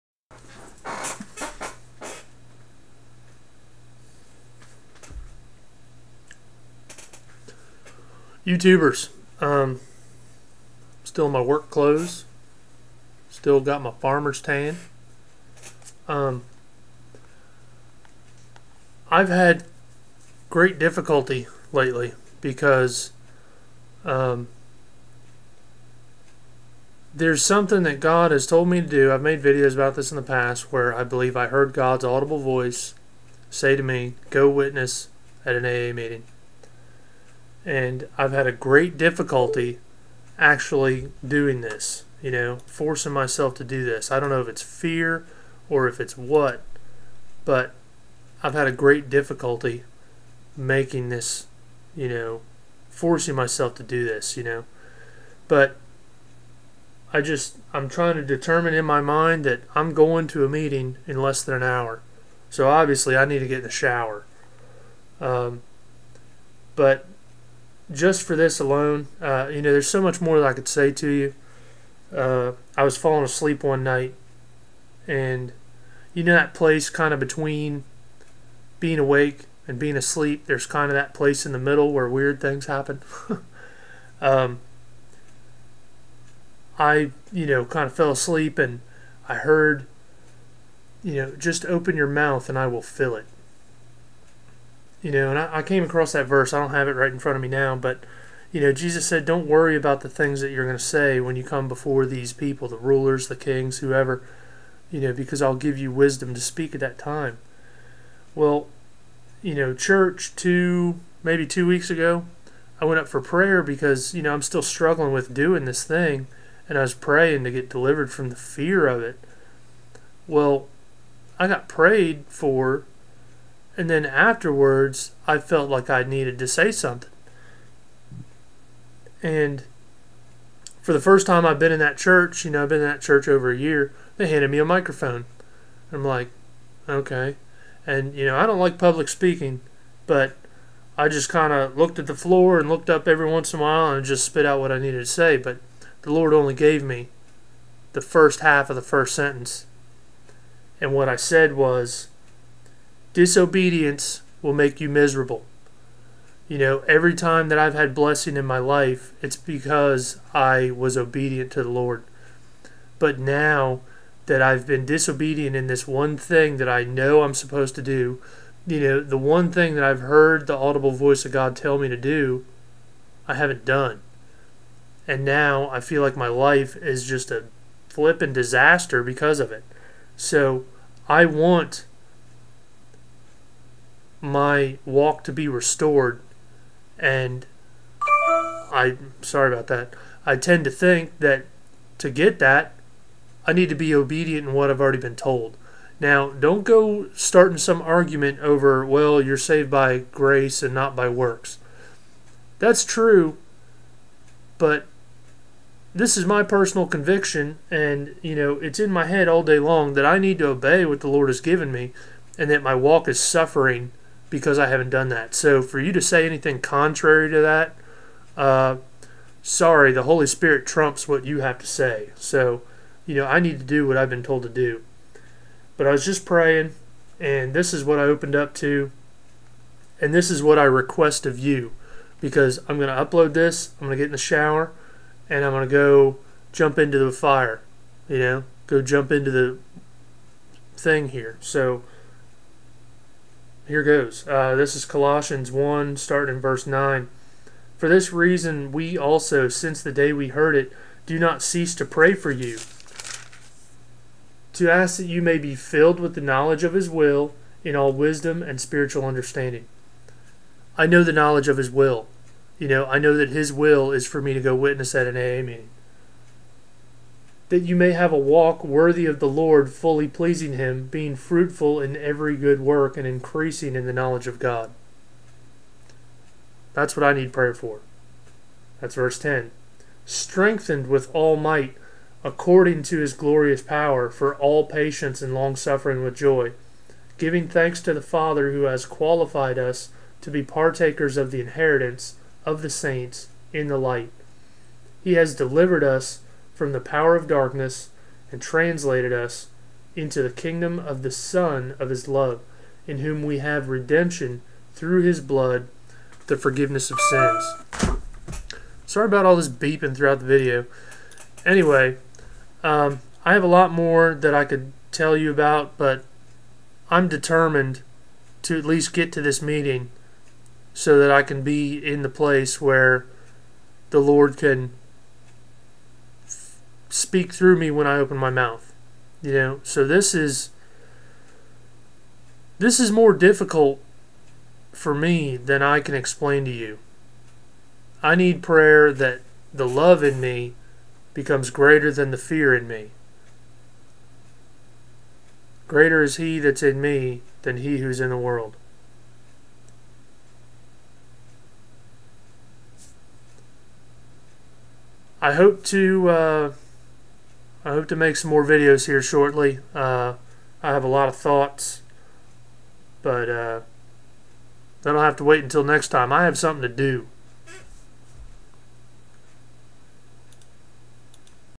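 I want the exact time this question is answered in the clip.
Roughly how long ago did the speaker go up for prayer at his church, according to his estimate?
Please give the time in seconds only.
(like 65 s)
111 s.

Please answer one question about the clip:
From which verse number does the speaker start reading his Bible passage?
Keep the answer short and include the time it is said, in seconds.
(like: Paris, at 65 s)
9, at 246 s.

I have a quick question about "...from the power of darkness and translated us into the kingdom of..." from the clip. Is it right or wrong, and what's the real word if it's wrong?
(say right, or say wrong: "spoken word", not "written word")
right.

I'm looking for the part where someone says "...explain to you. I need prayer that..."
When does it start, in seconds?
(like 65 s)
335 s.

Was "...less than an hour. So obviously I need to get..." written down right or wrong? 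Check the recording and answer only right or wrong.
right.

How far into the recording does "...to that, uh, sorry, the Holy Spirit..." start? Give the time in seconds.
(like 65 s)
217 s.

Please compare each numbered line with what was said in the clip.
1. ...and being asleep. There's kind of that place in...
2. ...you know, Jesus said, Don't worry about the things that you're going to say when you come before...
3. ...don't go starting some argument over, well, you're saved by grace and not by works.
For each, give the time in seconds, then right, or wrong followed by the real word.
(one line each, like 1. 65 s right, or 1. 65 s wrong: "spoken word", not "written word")
1. 79 s right
2. 98 s right
3. 196 s right.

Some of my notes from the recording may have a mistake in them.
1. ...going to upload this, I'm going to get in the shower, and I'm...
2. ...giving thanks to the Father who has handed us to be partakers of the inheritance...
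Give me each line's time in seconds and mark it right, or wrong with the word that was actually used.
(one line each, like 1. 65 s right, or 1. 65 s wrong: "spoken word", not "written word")
1. 232 s right
2. 287 s wrong: "qualified", not "handed".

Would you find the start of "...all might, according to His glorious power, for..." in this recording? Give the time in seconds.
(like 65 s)
281 s.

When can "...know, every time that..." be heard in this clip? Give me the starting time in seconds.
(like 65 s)
156 s.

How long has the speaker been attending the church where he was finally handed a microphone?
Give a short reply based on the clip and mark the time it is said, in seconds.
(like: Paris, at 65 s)
Over a year, at 133 s.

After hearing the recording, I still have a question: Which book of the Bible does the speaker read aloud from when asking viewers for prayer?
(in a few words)
Colossians.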